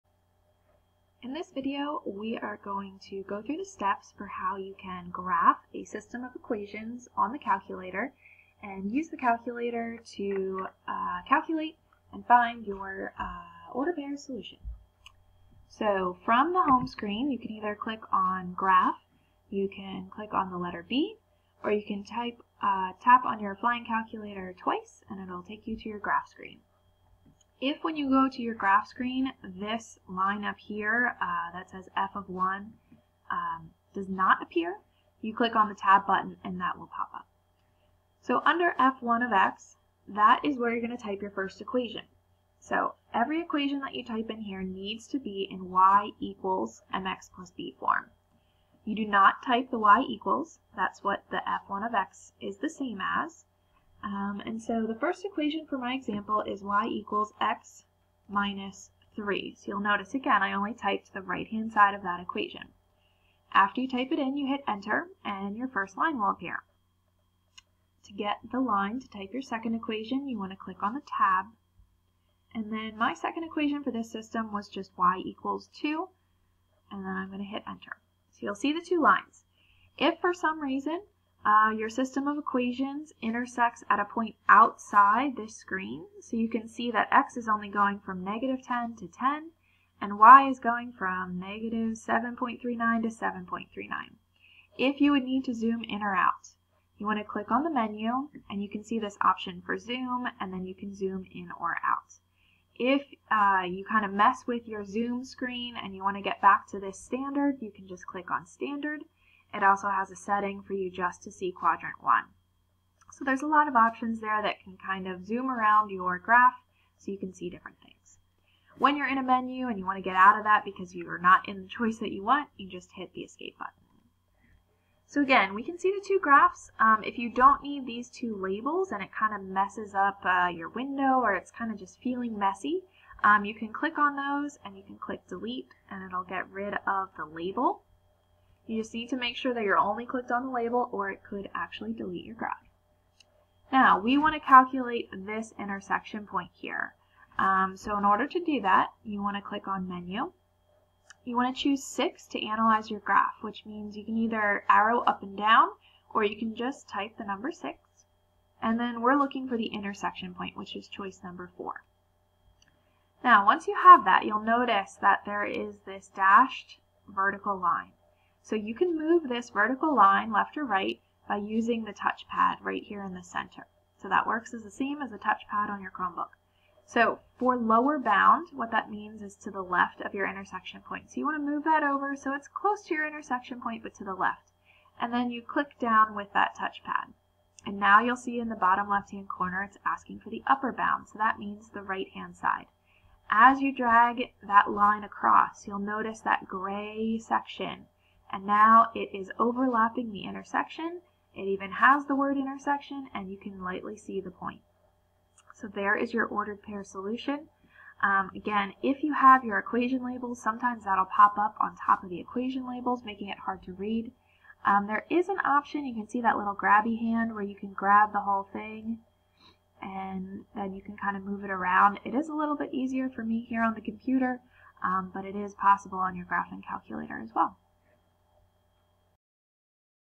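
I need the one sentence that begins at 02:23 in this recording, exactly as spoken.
Now, we want to calculate this intersection point here.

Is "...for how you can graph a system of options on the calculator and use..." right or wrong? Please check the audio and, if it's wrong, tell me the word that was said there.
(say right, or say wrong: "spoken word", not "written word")
wrong: "equations", not "options".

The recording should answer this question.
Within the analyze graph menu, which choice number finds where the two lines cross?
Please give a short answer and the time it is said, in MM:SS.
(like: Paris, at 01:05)
4, at 02:40.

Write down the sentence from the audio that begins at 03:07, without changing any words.
And now you'll see in the bottom left-hand corner it's asking for the upper bound, so that means the right-hand side.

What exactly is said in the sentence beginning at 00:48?
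You do not type the y equals, that's what the f1 of x is the same as.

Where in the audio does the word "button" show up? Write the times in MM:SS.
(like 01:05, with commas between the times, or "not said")
00:36, 02:03.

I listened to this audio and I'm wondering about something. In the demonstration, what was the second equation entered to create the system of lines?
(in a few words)
y = 2.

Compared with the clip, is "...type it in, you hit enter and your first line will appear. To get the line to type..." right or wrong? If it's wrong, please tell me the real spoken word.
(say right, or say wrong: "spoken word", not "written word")
right.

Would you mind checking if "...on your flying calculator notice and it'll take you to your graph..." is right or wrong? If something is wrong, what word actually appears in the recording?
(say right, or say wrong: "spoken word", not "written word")
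wrong: "twice", not "notice".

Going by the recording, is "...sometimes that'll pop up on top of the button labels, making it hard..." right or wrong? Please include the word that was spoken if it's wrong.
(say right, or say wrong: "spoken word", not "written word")
wrong: "equation", not "button".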